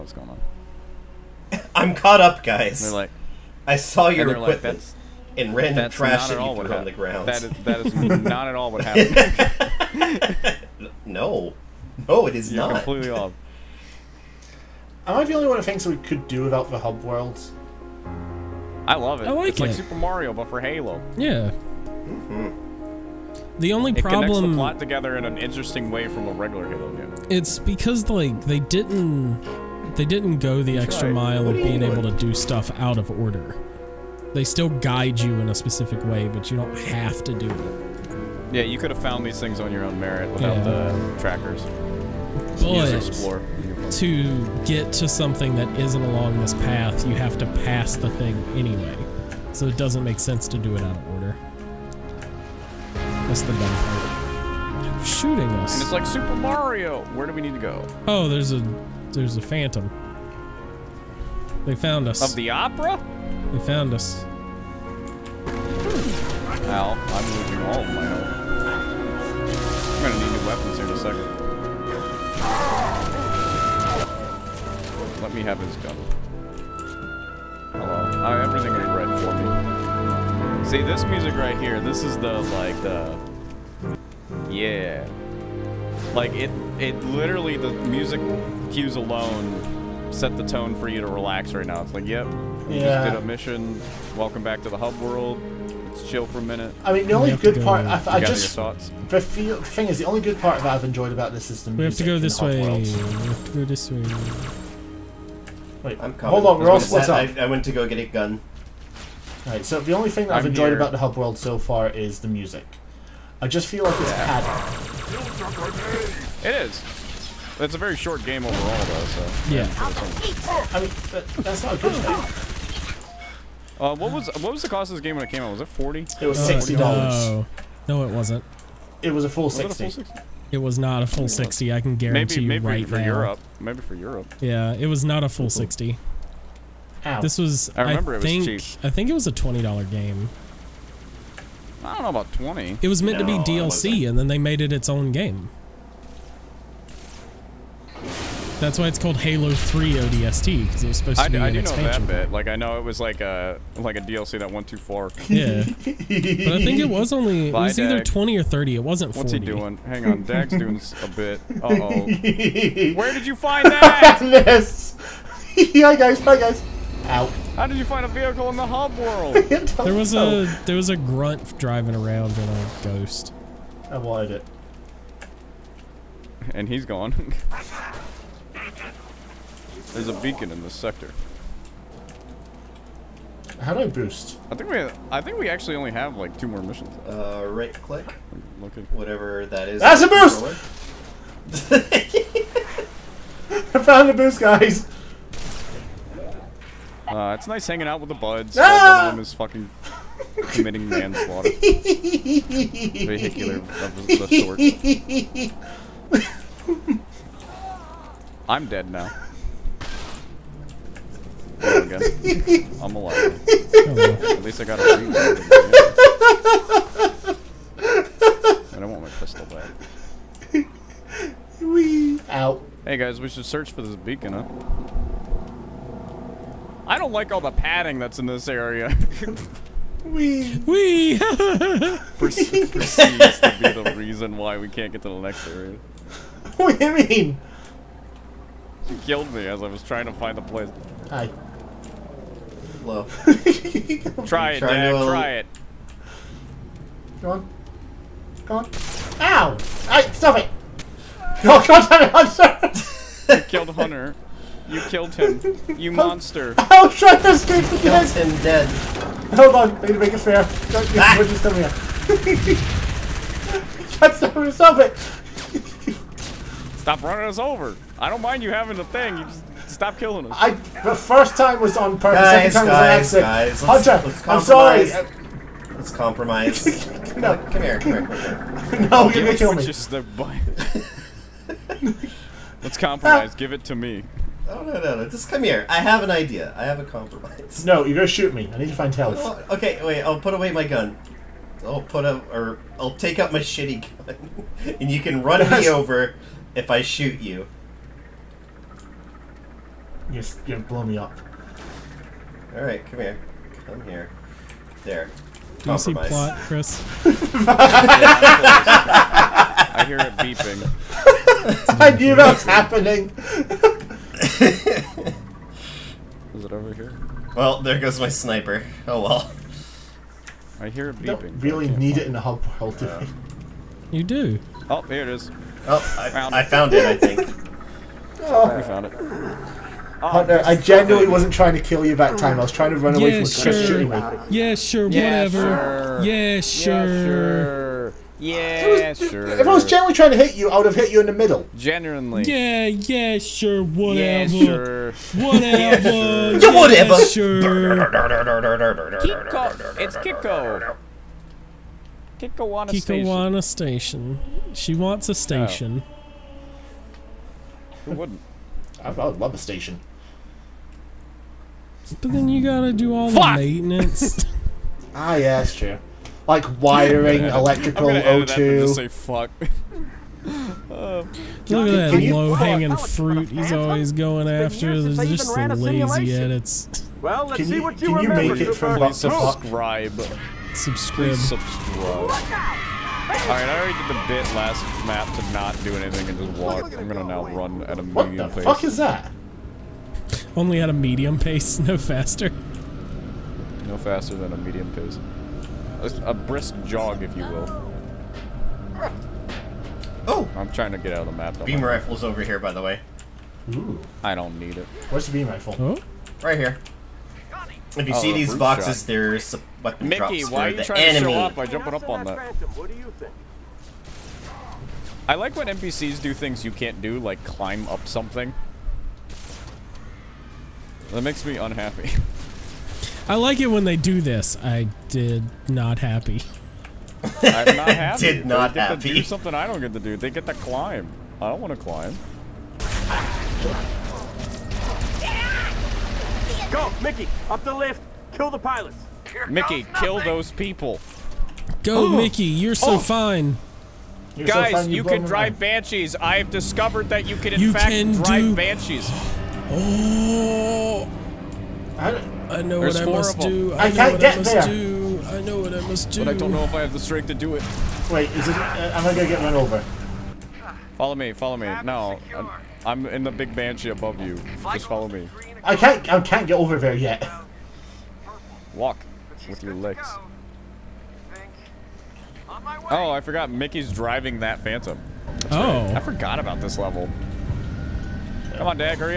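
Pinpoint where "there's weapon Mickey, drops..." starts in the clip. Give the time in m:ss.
6:48.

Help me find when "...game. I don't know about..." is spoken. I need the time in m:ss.
2:19.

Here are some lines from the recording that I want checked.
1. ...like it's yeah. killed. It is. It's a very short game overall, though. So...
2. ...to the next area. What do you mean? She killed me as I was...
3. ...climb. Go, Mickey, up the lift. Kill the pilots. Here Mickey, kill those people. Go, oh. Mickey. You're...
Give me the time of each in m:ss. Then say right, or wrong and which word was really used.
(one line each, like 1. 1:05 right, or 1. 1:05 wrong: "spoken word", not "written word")
1. 1:53 wrong: "padded", not "killed"
2. 3:55 right
3. 7:11 right.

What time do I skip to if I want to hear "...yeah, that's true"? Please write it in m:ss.
6:05.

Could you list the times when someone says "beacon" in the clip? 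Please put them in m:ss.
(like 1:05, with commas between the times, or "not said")
3:00, 3:43.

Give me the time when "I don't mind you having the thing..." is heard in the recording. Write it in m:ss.
4:27.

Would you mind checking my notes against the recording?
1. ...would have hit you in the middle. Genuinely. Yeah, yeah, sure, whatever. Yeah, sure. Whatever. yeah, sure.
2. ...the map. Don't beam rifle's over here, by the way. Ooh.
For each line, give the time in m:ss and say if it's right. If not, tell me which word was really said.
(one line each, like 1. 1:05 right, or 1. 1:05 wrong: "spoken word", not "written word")
1. 5:40 right
2. 6:41 right.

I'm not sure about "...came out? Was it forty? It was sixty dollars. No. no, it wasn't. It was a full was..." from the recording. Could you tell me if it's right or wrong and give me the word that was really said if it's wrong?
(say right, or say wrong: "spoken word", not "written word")
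right.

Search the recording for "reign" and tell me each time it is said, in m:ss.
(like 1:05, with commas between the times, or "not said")
not said.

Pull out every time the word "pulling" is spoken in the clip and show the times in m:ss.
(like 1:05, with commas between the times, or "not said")
not said.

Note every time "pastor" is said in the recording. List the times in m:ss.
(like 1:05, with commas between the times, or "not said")
not said.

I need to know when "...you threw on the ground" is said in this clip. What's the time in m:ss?
0:06.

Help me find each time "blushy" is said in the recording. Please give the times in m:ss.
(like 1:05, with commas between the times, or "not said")
not said.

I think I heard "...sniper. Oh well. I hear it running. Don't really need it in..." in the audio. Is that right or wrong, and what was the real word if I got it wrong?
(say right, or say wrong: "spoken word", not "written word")
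wrong: "beeping", not "running".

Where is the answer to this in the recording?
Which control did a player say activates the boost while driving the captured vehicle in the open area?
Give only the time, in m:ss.
3:07.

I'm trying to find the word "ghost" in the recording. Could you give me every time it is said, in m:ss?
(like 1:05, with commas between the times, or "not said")
2:52.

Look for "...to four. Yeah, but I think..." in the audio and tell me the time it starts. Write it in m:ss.
2:34.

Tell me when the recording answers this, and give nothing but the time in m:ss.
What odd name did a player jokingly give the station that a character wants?
5:53.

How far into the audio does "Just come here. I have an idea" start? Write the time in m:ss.
4:45.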